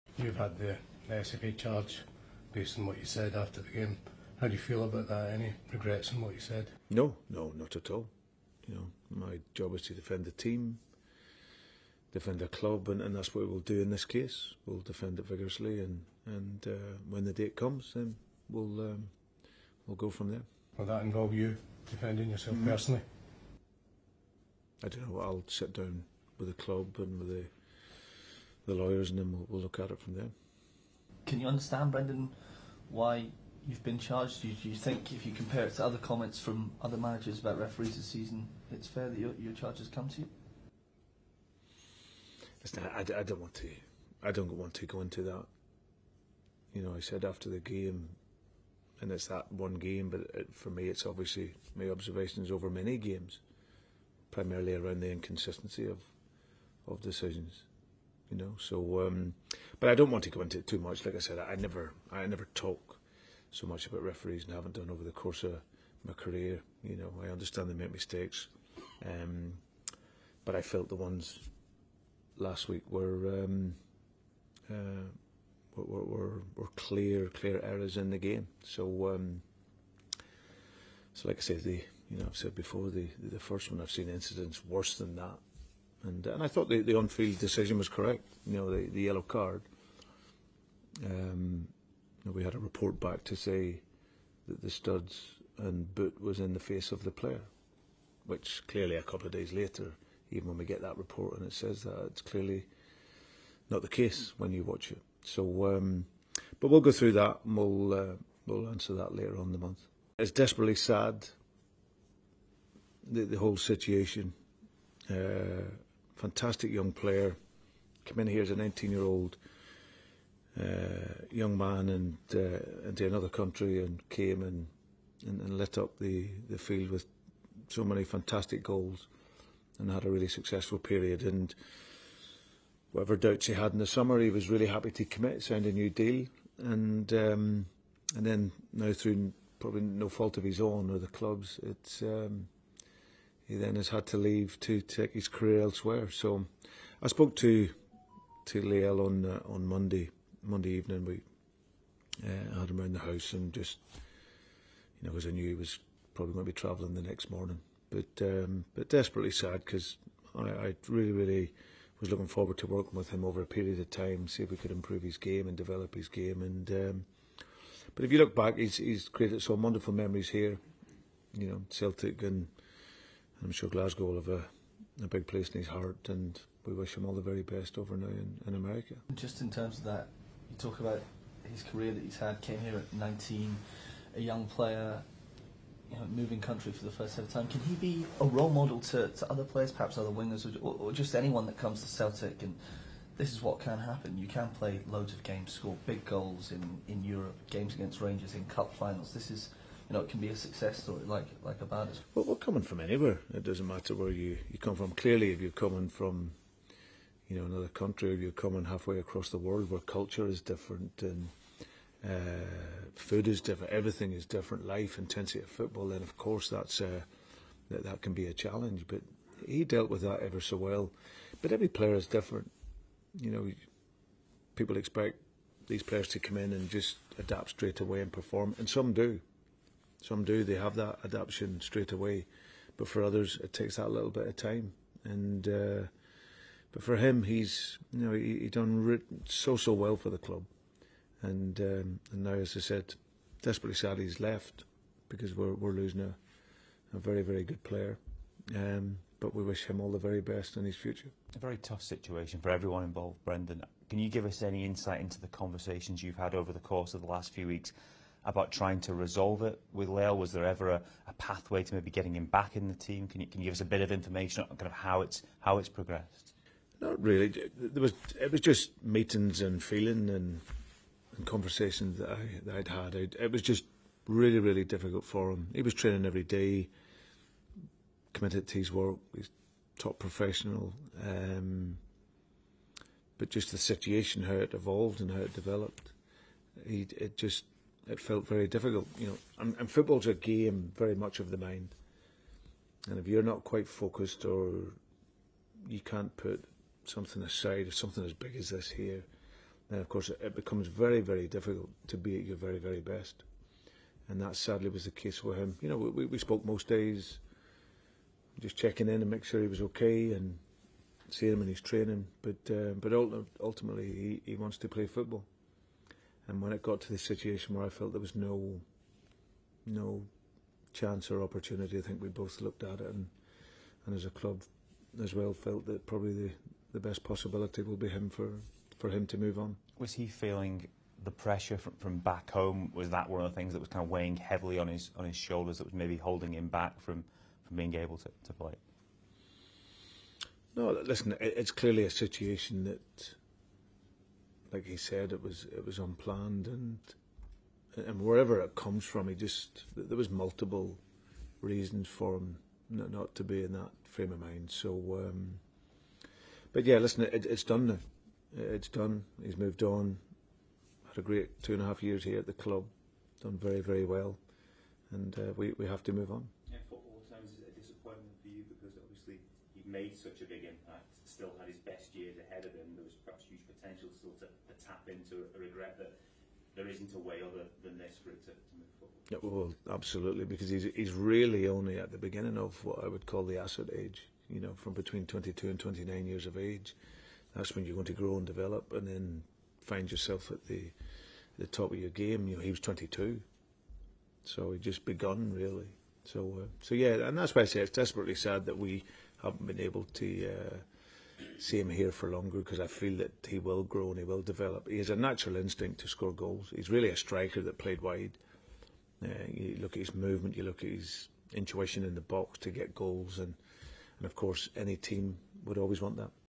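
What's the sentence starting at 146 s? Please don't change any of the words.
So I spoke to to Liel on uh, on Monday Monday evening.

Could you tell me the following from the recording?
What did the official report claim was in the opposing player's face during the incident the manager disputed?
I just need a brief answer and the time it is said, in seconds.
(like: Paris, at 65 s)
Studs and boot, at 94 s.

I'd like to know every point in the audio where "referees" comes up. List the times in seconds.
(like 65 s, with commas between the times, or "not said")
37 s, 64 s.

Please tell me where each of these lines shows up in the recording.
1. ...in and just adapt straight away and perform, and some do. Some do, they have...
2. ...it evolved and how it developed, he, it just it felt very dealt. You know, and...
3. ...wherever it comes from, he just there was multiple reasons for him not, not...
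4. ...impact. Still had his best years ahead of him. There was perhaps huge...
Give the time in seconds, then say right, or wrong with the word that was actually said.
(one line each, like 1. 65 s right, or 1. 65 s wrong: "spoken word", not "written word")
1. 226 s right
2. 284 s wrong: "difficult", not "dealt"
3. 348 s right
4. 370 s right.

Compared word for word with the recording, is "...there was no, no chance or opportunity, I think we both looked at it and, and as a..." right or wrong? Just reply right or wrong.
right.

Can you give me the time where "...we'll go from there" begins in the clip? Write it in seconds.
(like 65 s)
19 s.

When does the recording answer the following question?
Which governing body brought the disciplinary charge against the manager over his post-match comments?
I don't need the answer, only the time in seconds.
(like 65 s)
1 s.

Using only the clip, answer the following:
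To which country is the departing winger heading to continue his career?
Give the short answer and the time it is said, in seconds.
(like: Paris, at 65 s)
America, at 178 s.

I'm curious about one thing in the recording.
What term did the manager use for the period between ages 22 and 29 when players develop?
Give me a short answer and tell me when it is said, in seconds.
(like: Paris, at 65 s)
Asset age, at 383 s.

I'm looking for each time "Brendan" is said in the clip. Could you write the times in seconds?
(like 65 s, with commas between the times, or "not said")
31 s, 253 s.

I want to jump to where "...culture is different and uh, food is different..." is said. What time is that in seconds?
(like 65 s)
209 s.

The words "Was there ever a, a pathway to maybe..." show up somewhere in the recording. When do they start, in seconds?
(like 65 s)
260 s.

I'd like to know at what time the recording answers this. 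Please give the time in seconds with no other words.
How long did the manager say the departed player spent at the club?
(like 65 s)
361 s.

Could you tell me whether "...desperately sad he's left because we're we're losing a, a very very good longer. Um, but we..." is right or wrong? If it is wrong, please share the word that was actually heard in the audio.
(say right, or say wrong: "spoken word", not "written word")
wrong: "player", not "longer".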